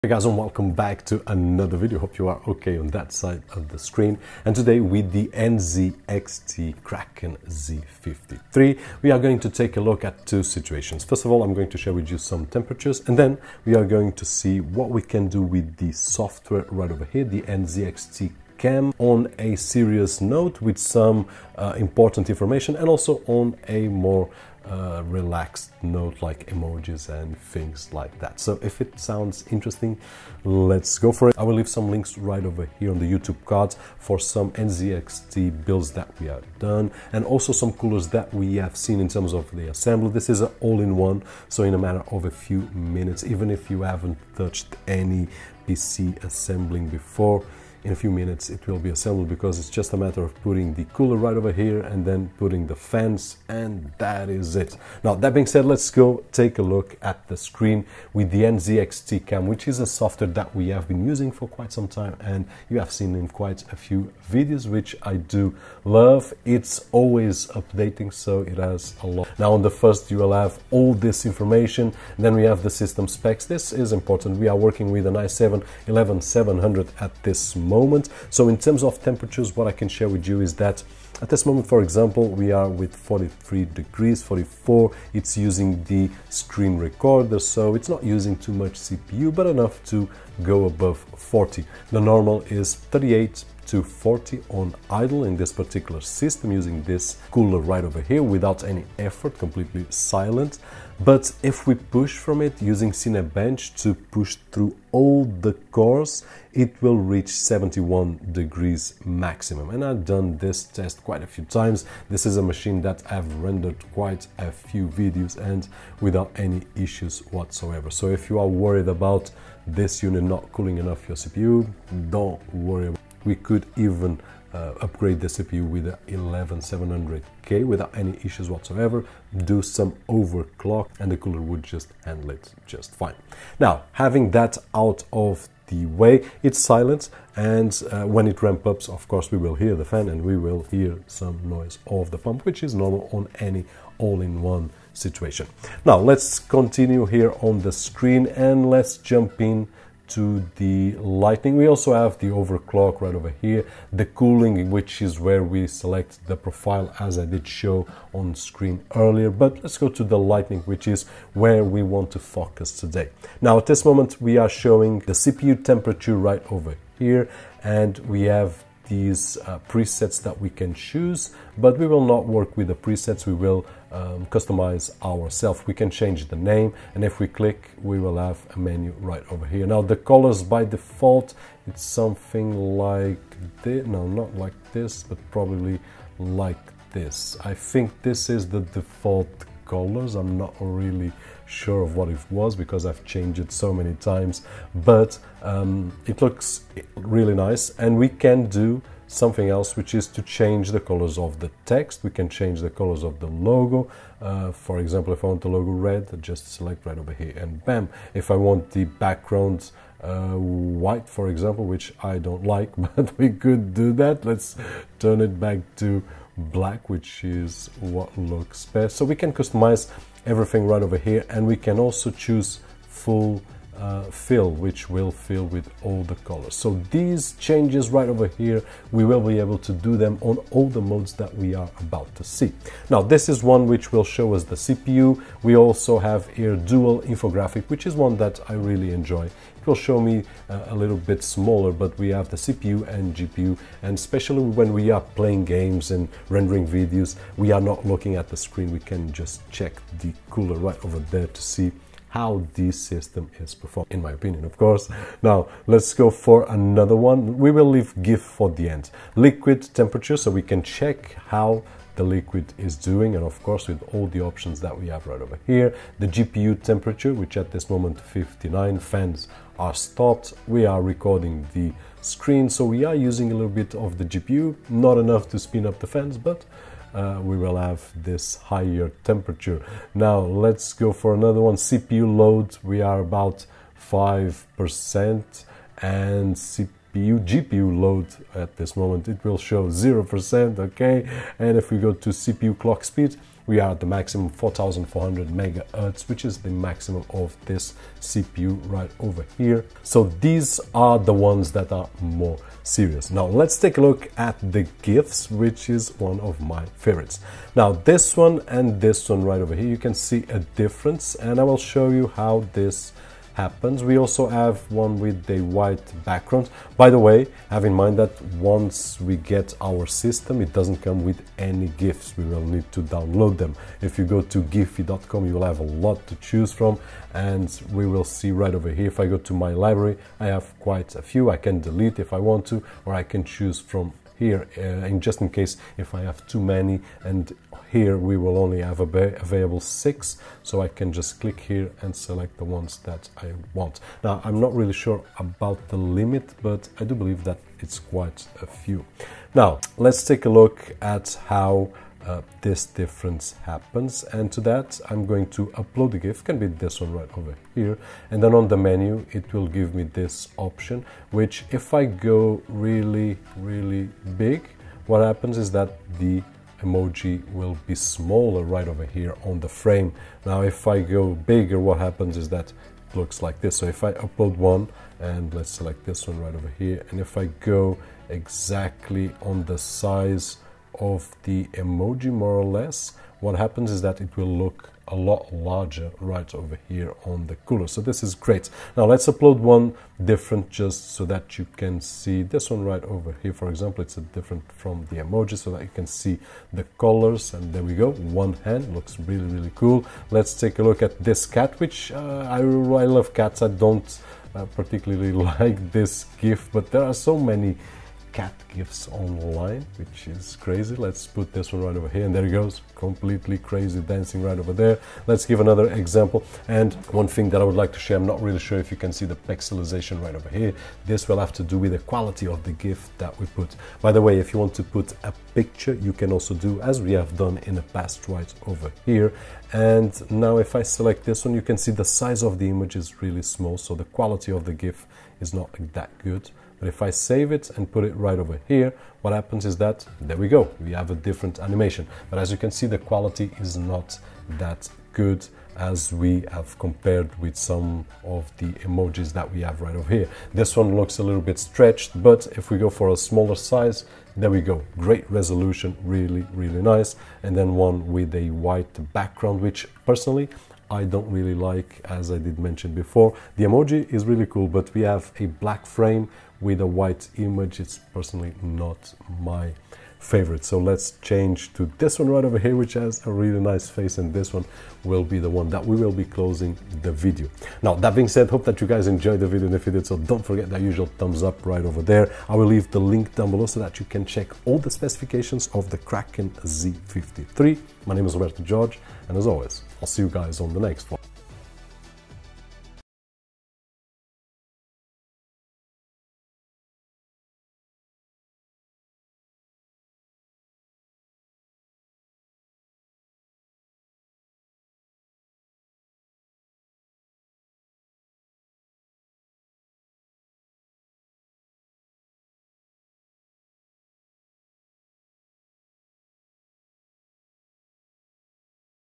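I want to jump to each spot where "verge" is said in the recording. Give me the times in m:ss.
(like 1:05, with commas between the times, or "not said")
not said.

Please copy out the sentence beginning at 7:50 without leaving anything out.
So let's change to this one right over here, which has a really nice face.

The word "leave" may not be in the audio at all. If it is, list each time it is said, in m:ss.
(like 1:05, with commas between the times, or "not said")
0:31, 4:17, 8:02.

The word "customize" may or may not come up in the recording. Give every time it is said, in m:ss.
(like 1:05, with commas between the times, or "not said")
2:54, 3:39.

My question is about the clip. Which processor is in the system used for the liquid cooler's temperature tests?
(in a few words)
i7 11700.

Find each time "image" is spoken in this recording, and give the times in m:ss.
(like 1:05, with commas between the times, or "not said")
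7:12, 7:47.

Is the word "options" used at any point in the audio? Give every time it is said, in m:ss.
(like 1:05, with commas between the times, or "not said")
4:24, 6:00.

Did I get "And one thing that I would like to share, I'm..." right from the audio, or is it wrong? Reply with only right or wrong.
right.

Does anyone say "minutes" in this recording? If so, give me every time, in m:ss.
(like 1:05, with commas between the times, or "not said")
0:42, 0:48.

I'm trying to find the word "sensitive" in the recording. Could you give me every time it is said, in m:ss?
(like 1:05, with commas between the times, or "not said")
not said.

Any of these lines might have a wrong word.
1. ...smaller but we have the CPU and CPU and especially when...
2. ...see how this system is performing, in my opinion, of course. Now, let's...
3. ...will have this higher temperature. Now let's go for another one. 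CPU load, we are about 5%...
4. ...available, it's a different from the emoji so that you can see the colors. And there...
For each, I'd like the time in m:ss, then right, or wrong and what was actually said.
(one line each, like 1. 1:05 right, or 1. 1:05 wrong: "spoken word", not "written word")
1. 4:01 wrong: "GPU", not "CPU"
2. 4:11 right
3. 4:37 right
4. 6:33 wrong: "example", not "available".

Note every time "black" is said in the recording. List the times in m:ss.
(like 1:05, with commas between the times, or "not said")
3:36, 7:45.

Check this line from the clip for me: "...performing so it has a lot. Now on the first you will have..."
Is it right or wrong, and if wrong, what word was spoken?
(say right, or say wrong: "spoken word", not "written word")
wrong: "updating", not "performing".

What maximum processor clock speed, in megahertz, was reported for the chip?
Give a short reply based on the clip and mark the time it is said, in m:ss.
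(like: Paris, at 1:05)
4400, at 4:54.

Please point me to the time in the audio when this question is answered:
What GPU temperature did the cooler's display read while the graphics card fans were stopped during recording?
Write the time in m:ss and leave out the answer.
4:27.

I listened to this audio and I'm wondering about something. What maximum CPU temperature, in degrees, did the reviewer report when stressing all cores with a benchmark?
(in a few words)
71.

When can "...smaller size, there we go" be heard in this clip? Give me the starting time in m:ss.
7:32.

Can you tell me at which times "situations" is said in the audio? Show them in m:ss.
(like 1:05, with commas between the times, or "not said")
0:10, 2:24.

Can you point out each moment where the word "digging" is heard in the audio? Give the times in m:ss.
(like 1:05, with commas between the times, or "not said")
not said.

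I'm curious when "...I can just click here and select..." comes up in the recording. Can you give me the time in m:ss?
5:40.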